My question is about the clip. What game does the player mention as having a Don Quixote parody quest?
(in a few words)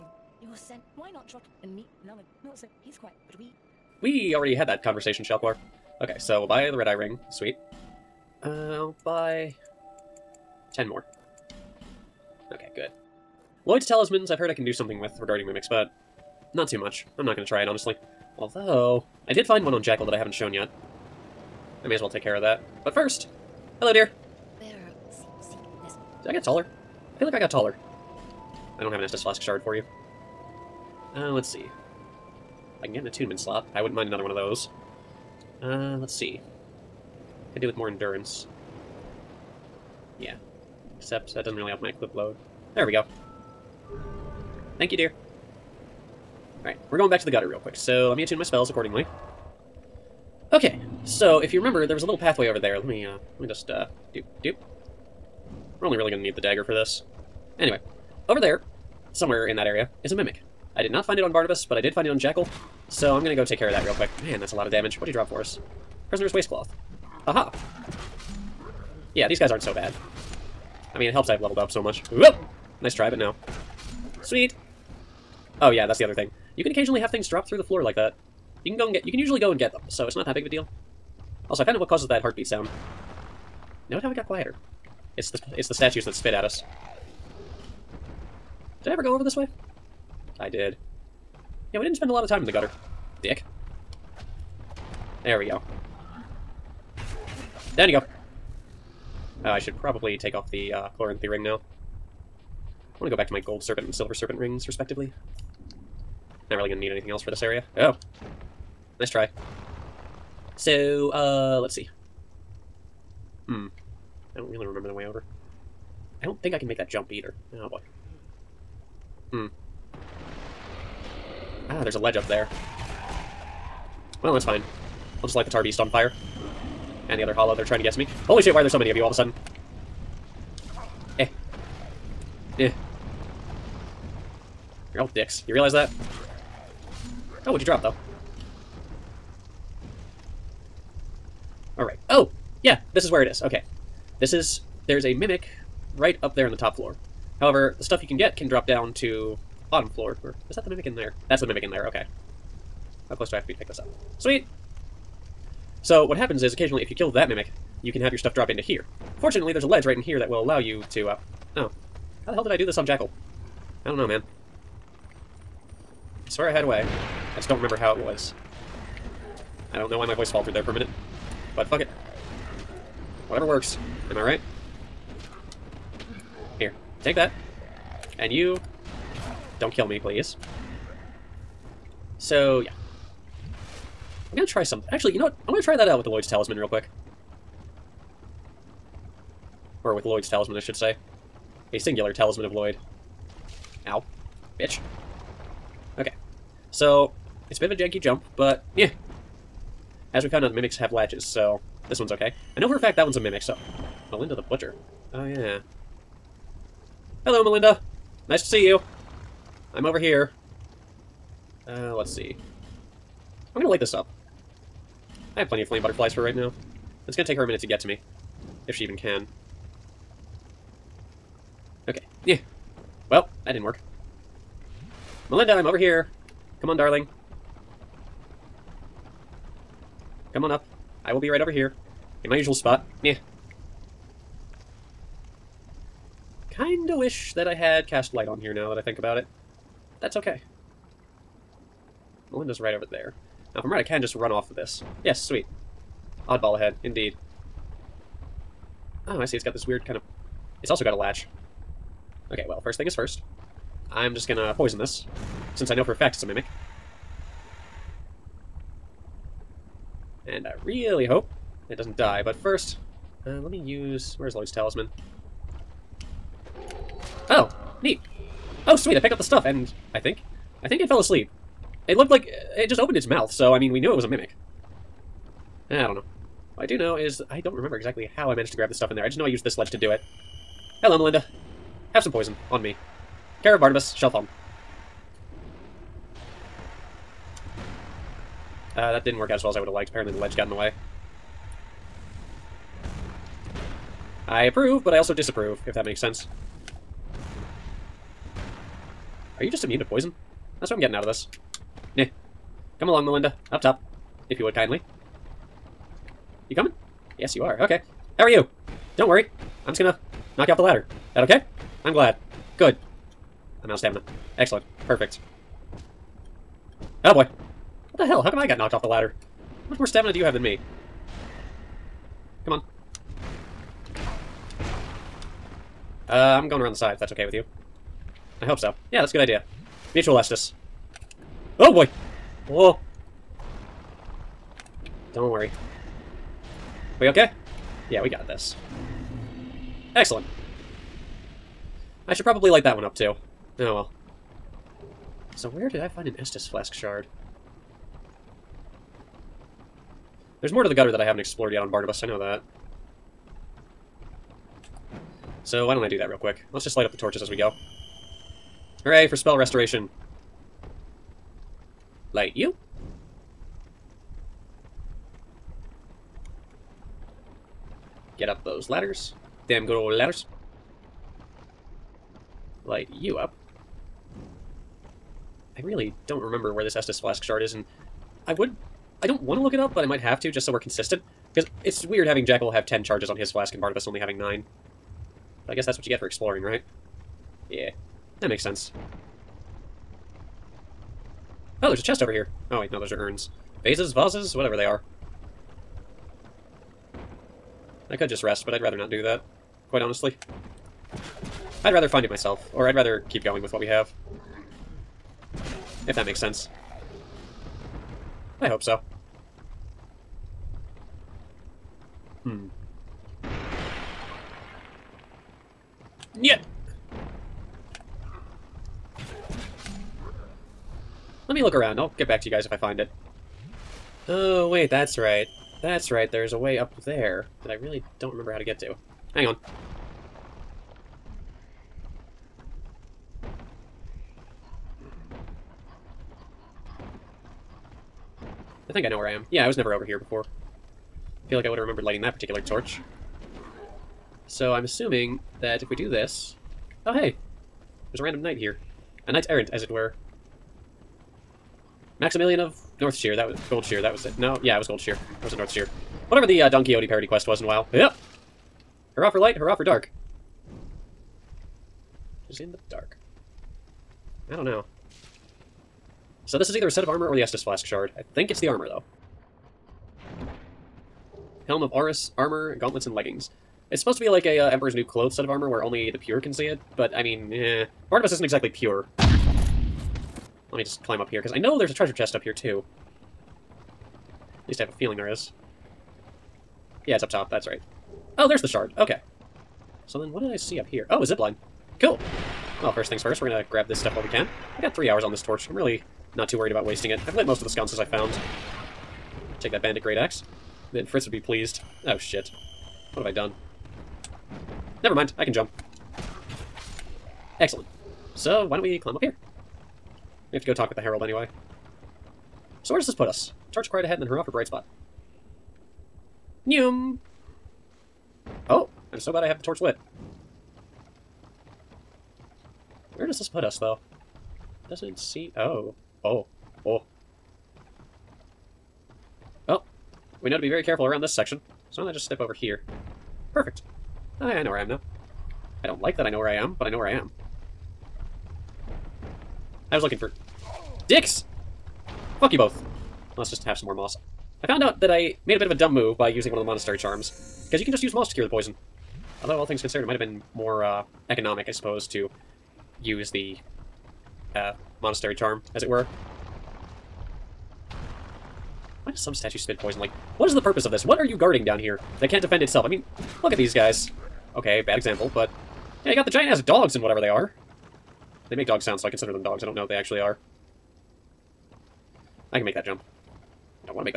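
WoW.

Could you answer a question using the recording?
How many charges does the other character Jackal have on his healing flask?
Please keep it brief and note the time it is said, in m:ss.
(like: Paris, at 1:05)
10, at 6:22.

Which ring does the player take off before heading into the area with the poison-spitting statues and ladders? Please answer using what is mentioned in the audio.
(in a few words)
Chloranthy ring.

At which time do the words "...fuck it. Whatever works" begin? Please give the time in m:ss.
2:51.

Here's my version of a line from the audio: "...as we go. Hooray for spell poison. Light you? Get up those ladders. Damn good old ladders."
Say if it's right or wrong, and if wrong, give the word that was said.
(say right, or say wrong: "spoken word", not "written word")
wrong: "restoration", not "poison".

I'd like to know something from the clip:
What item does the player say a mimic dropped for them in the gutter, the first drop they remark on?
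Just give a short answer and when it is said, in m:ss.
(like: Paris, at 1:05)
Prisoner's waistcloth, at 1:06.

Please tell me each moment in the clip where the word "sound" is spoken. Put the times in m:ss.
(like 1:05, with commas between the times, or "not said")
1:22, 9:28.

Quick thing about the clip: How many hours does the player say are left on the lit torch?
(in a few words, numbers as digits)
3.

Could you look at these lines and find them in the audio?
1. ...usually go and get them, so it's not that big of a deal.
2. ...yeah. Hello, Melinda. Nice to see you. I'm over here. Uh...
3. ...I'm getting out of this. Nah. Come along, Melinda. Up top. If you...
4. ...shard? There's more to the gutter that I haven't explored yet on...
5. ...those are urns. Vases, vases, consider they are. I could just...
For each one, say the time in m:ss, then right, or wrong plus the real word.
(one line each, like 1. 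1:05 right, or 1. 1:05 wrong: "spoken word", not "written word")
1. 1:19 right
2. 3:25 right
3. 5:00 right
4. 5:46 right
5. 6:32 wrong: "whatever", not "consider".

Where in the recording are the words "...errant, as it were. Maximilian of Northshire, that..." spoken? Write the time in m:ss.
7:29.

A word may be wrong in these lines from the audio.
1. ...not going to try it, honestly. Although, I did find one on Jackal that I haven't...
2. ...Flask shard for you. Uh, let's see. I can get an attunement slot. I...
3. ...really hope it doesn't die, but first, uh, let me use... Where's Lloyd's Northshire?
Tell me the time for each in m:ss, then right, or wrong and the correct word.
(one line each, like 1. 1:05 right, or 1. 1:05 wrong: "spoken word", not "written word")
1. 0:17 right
2. 0:29 right
3. 4:20 wrong: "Talisman", not "Northshire".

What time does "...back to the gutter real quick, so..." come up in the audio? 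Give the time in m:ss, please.
0:47.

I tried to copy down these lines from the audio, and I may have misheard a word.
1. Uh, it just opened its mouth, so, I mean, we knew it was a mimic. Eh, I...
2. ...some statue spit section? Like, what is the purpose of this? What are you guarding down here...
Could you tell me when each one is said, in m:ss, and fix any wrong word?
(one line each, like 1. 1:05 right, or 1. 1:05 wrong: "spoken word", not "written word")
1. 4:32 right
2. 9:18 wrong: "poison", not "section".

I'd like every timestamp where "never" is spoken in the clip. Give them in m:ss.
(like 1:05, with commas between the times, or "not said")
7:19, 8:24.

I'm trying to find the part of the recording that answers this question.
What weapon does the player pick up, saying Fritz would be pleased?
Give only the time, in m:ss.
8:19.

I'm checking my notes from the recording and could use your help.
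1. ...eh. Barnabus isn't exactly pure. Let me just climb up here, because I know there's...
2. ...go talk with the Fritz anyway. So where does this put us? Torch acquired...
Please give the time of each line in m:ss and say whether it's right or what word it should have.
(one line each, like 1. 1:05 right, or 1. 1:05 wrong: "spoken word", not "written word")
1. 7:57 right
2. 8:30 wrong: "Herald", not "Fritz".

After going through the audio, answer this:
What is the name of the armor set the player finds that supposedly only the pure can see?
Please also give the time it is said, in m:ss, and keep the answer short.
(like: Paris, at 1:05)
Aurous, at 7:51.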